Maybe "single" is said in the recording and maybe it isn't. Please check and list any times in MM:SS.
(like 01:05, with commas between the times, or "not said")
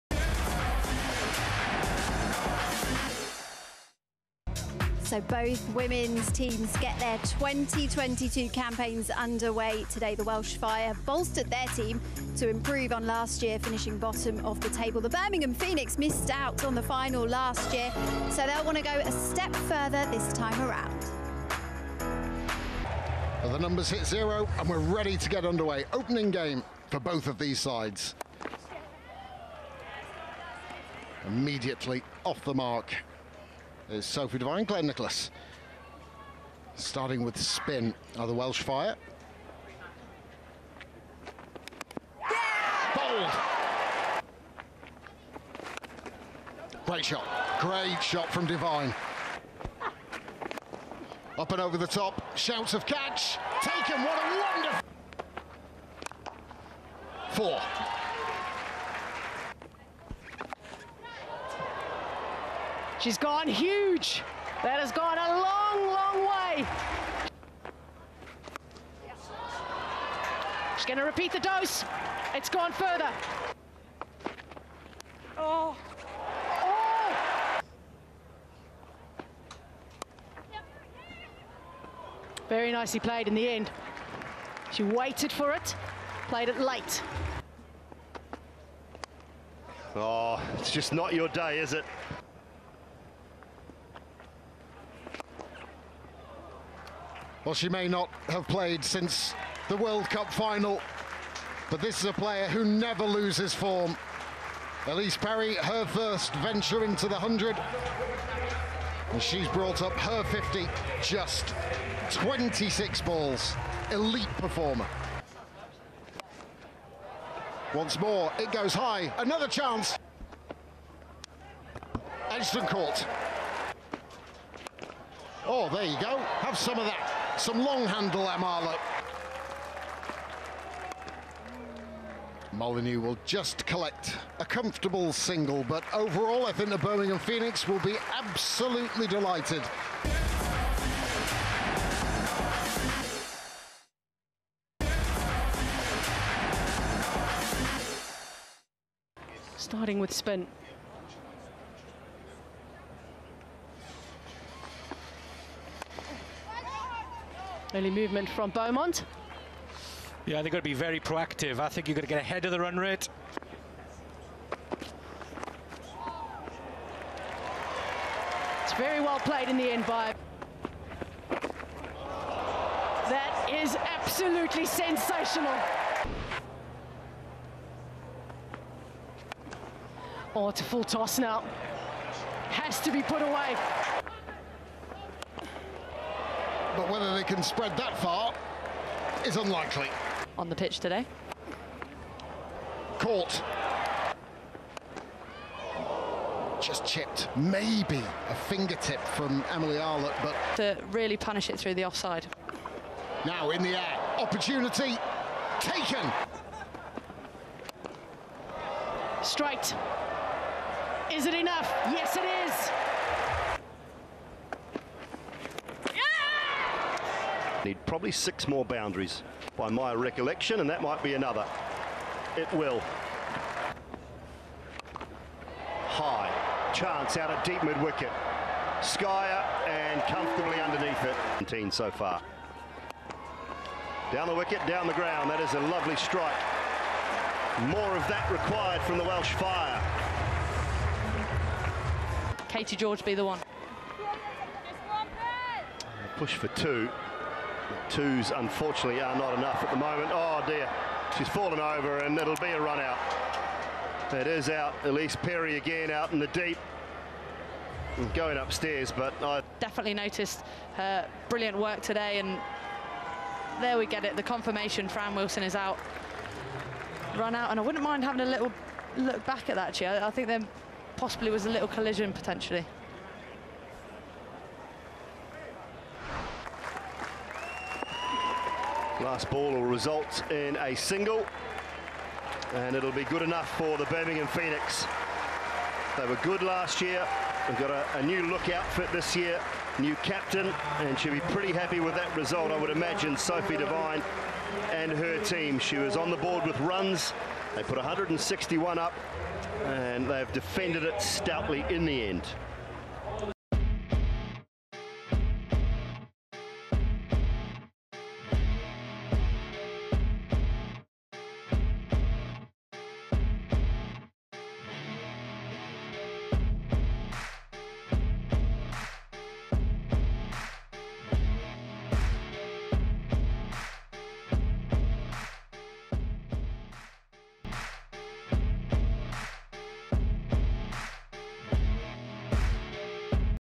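02:15, 04:40.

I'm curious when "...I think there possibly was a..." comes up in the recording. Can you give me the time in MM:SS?
04:30.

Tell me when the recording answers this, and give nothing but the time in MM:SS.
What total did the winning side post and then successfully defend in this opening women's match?
04:57.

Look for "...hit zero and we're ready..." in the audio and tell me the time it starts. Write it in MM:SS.
00:23.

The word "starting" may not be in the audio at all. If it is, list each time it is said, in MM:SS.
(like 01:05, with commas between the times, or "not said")
00:36, 02:29.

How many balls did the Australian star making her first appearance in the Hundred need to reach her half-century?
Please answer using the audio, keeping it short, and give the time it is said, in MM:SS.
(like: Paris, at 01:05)
26, at 01:51.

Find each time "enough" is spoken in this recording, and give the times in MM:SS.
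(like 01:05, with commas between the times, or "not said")
03:31, 04:09, 04:43.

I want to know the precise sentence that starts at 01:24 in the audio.
She waited for it, played it late.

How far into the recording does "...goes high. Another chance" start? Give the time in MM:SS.
01:58.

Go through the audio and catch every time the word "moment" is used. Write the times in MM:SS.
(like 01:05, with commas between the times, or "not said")
04:09.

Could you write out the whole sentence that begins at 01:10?
She's going to repeat the dose.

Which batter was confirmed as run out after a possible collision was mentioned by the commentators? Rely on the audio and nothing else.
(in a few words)
Fran Wilson.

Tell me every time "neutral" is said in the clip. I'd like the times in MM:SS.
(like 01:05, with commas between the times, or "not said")
not said.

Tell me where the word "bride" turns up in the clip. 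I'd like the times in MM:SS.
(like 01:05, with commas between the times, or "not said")
not said.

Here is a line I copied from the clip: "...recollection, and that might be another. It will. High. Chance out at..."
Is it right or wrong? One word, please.
right.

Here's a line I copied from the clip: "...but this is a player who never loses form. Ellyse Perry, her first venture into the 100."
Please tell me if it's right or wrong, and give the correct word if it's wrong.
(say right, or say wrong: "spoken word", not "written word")
right.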